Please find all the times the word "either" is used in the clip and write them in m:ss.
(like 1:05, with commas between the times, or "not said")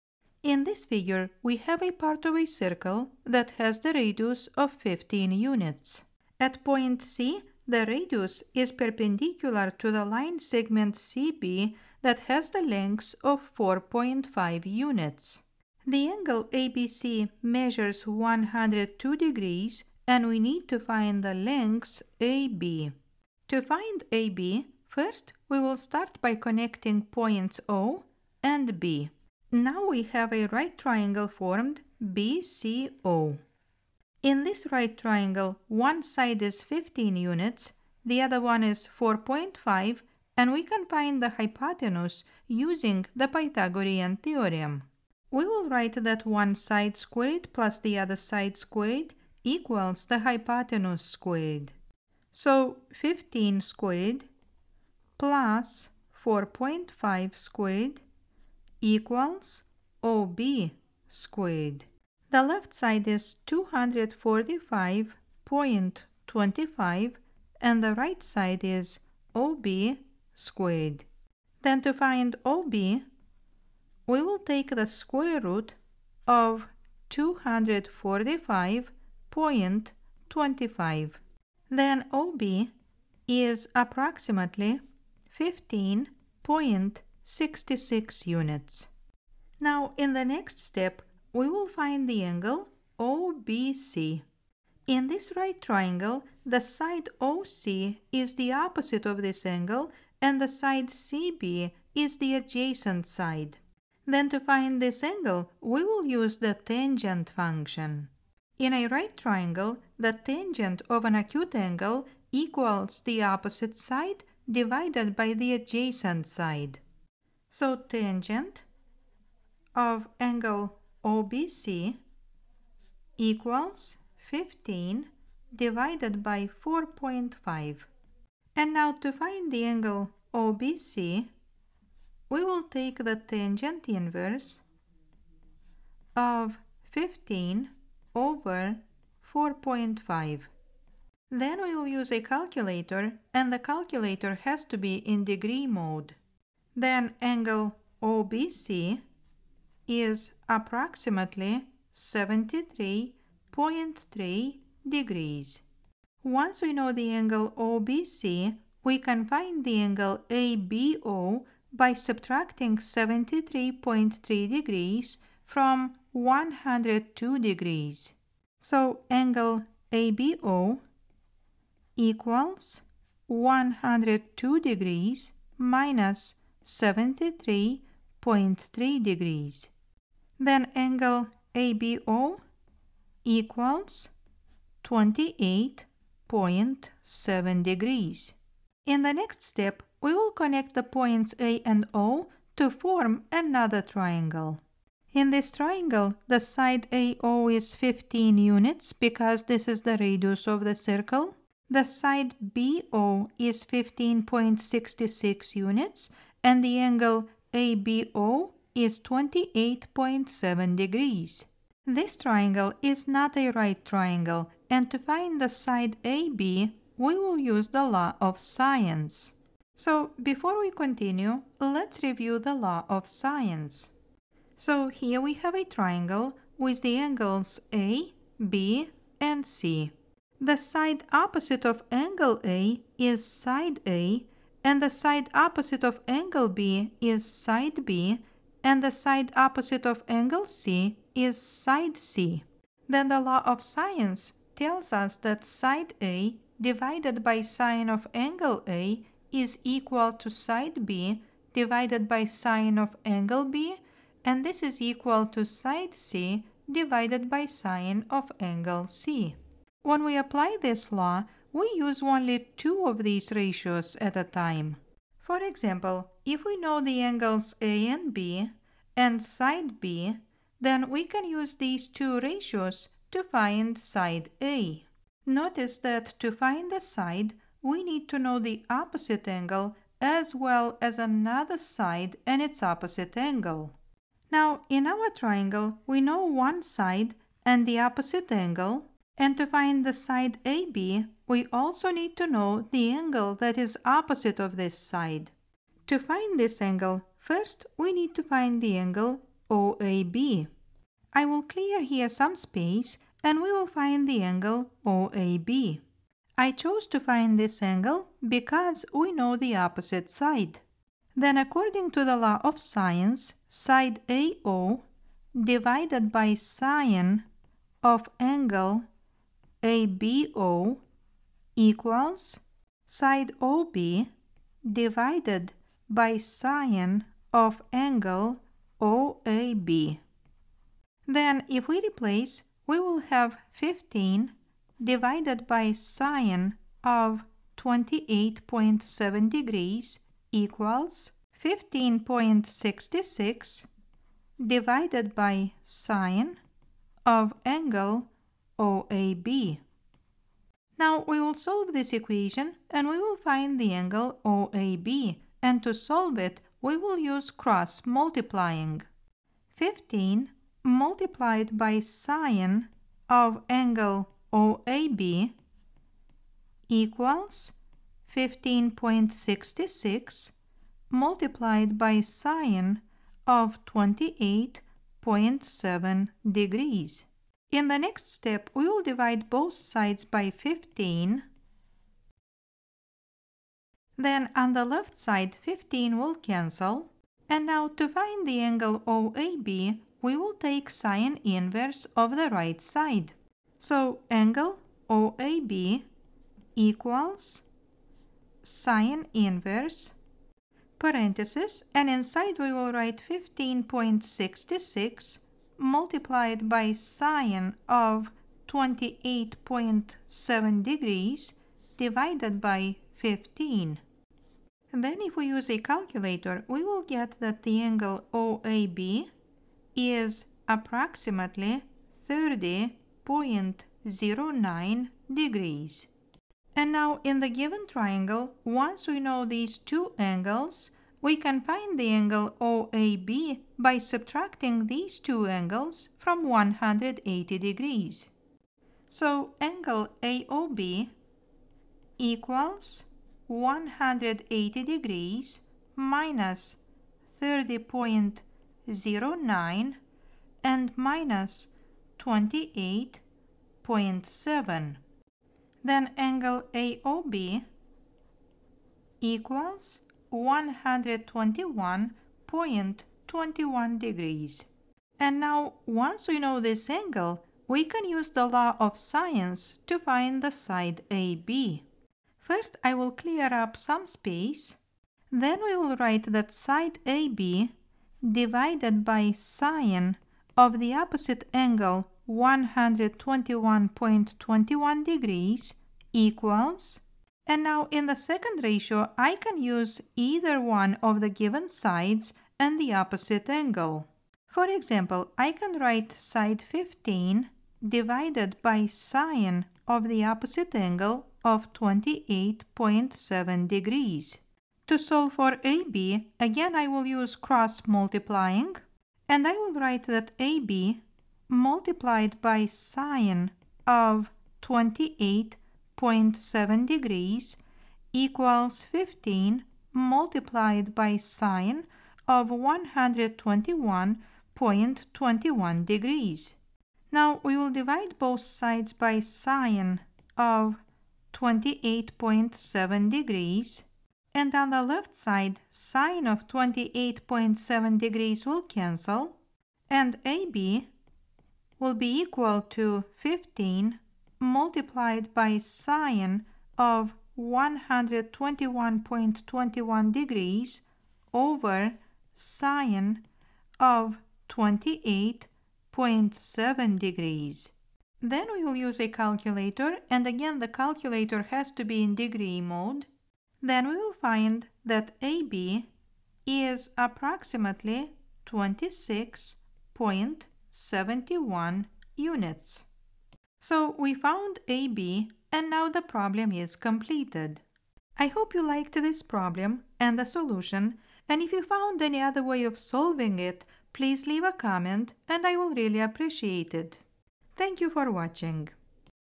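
8:09.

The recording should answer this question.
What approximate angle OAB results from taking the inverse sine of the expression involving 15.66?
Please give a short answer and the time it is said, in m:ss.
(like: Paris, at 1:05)
30.09 degrees, at 7:02.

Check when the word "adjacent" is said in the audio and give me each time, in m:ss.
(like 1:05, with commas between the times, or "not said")
1:42, 1:55.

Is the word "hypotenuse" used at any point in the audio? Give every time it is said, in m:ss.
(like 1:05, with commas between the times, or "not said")
0:41, 0:50.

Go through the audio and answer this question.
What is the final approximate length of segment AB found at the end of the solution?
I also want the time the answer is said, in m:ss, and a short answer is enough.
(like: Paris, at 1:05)
26.71 units, at 9:28.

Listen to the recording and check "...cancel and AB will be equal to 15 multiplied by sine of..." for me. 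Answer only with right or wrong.
right.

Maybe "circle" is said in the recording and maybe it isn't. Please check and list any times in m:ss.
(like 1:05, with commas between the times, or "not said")
0:02, 3:20.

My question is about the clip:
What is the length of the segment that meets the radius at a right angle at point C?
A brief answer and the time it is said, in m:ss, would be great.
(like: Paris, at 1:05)
4.5 units, at 0:13.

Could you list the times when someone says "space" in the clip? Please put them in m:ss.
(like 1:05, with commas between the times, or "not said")
5:02, 7:53.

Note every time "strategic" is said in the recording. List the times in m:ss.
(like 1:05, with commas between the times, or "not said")
not said.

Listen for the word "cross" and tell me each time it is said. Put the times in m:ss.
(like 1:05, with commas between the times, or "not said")
5:57, 8:27.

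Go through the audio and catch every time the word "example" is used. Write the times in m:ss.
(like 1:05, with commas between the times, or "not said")
4:25, 8:14.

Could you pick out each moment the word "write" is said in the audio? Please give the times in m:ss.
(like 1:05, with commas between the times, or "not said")
0:45, 6:42, 7:55, 8:15, 8:29.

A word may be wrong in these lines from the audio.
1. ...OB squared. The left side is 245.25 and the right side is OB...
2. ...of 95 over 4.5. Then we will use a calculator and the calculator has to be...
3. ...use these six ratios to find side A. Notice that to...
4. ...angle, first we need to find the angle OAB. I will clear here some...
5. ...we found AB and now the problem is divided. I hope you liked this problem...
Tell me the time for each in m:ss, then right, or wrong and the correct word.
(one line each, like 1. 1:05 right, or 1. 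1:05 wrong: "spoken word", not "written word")
1. 1:00 right
2. 2:16 wrong: "15", not "95"
3. 4:31 wrong: "two", not "six"
4. 4:56 right
5. 9:33 wrong: "completed", not "divided".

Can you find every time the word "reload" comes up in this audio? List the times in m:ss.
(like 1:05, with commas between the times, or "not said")
not said.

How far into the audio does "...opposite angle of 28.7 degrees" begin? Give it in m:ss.
8:20.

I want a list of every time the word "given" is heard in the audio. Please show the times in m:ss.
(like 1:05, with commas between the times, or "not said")
7:07, 8:11.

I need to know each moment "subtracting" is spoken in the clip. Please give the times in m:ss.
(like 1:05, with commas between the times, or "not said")
2:41, 7:13.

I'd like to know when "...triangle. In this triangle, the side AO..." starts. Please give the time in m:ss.
3:13.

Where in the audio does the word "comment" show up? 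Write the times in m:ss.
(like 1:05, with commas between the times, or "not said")
9:44.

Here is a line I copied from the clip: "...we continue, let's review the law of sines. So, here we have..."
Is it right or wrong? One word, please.
right.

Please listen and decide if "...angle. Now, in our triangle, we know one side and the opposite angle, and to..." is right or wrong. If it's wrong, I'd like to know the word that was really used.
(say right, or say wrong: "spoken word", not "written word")
right.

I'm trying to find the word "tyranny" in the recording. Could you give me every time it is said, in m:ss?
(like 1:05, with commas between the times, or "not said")
not said.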